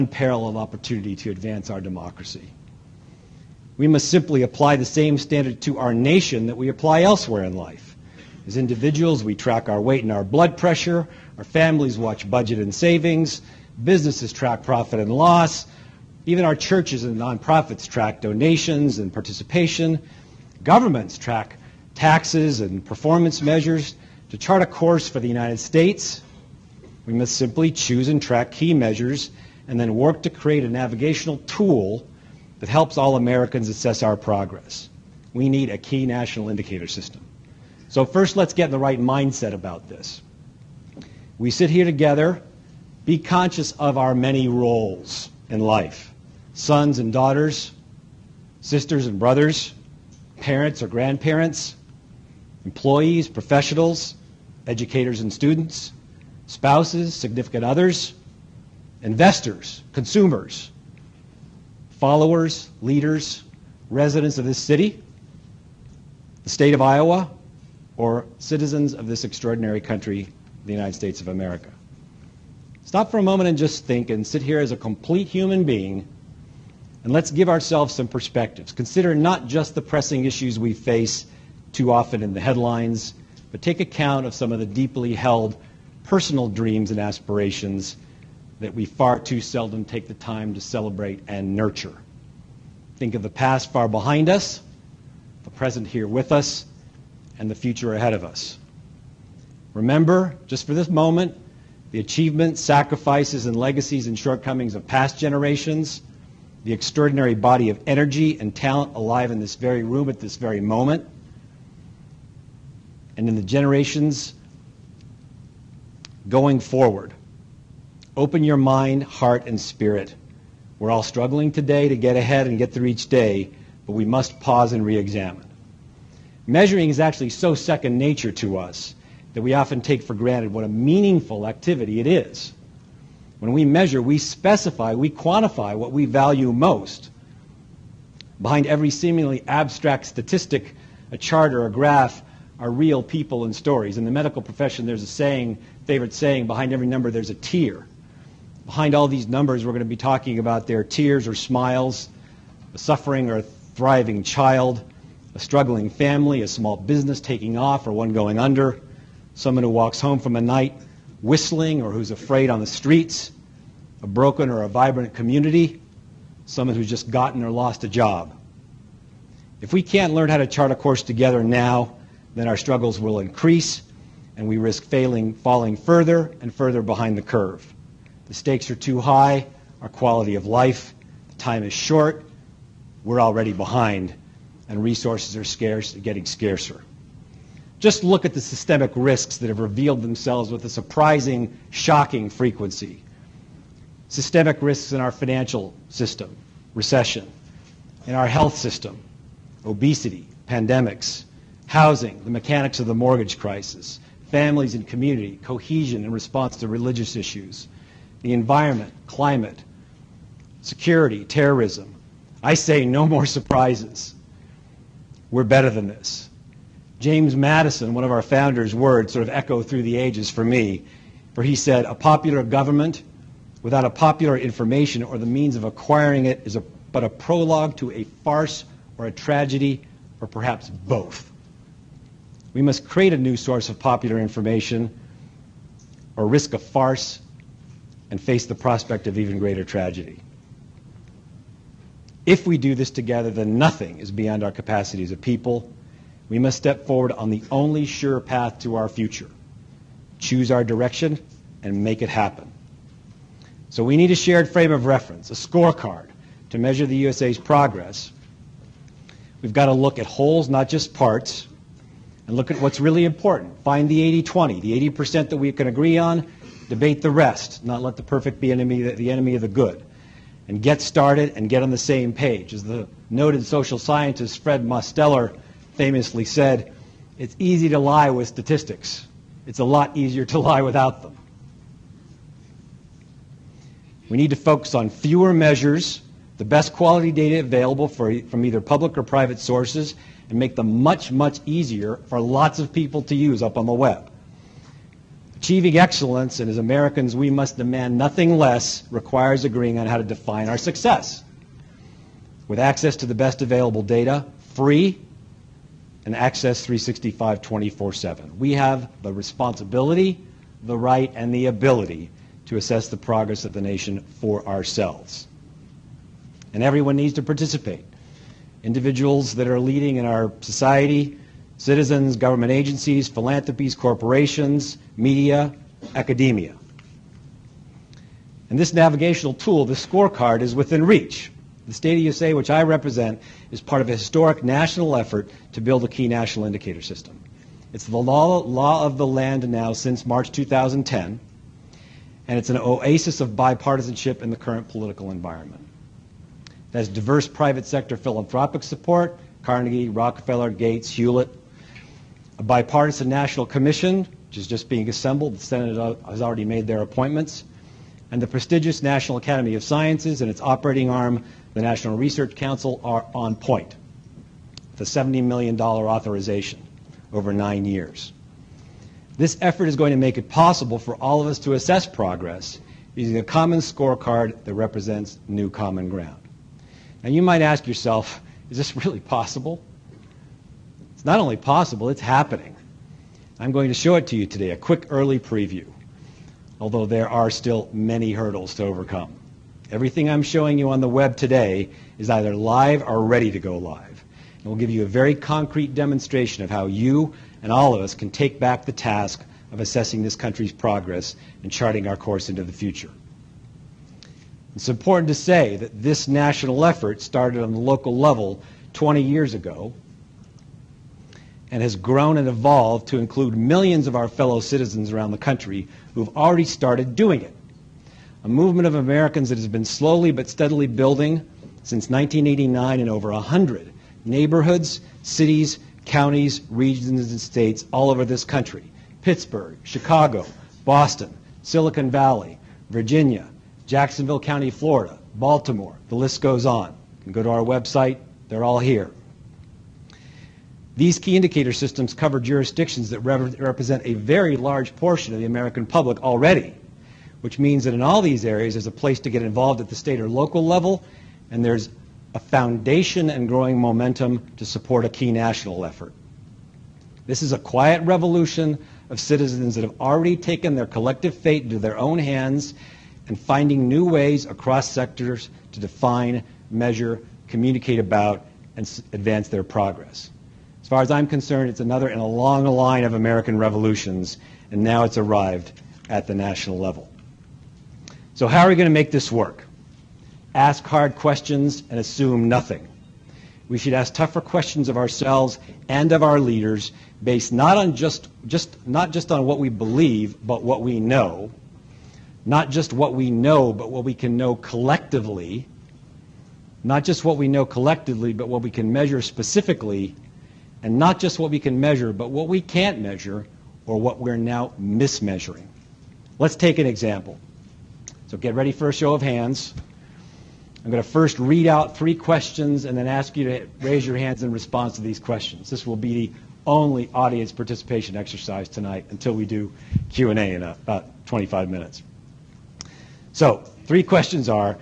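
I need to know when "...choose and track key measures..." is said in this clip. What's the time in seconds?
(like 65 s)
27 s.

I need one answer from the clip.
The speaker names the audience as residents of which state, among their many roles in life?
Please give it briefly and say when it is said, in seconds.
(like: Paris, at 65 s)
Iowa, at 66 s.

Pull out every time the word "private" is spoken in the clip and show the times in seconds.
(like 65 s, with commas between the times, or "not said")
289 s, 347 s.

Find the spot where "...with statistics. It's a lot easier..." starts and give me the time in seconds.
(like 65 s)
278 s.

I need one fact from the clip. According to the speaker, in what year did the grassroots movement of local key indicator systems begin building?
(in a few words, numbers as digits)
1989.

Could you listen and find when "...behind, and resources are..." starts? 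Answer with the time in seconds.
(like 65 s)
183 s.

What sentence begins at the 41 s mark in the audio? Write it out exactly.
We sit here together, be conscious of our many roles in life.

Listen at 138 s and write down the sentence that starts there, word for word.
Behind every seemingly abstract statistic, a chart or a graph, are real people and stories.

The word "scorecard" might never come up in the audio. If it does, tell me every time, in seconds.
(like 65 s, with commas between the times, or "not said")
255 s, 329 s, 373 s.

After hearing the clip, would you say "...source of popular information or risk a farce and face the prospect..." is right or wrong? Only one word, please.
right.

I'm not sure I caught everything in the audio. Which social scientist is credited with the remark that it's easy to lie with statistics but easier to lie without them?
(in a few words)
Fred Mosteller.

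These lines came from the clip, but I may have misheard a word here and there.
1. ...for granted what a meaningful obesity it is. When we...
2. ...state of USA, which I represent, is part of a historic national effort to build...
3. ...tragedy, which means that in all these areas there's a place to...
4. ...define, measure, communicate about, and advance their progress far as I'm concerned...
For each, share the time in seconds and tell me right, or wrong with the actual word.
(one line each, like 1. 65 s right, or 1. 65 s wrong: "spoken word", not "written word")
1. 130 s wrong: "activity", not "obesity"
2. 331 s right
3. 446 s wrong: "already", not "tragedy"
4. 465 s right.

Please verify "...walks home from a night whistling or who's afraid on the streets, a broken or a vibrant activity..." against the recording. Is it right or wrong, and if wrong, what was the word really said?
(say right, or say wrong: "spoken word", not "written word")
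wrong: "community", not "activity".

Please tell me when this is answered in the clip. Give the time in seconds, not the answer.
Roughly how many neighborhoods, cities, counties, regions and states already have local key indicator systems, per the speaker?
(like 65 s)
422 s.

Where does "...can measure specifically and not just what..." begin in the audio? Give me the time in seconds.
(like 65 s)
498 s.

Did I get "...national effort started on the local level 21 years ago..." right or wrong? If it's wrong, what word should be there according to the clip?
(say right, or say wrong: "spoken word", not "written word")
wrong: "20", not "21".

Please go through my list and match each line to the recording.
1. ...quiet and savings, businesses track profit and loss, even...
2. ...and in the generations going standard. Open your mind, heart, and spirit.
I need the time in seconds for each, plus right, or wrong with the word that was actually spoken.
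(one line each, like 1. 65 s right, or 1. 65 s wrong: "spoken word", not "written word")
1. 12 s wrong: "budget", not "quiet"
2. 113 s wrong: "forward", not "standard".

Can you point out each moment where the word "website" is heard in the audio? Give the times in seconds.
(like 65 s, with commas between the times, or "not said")
437 s.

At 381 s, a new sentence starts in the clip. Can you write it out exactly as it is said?
It's not only possible, it's happening.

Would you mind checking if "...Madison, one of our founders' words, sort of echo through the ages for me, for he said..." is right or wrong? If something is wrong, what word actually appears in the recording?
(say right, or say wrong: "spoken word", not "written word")
right.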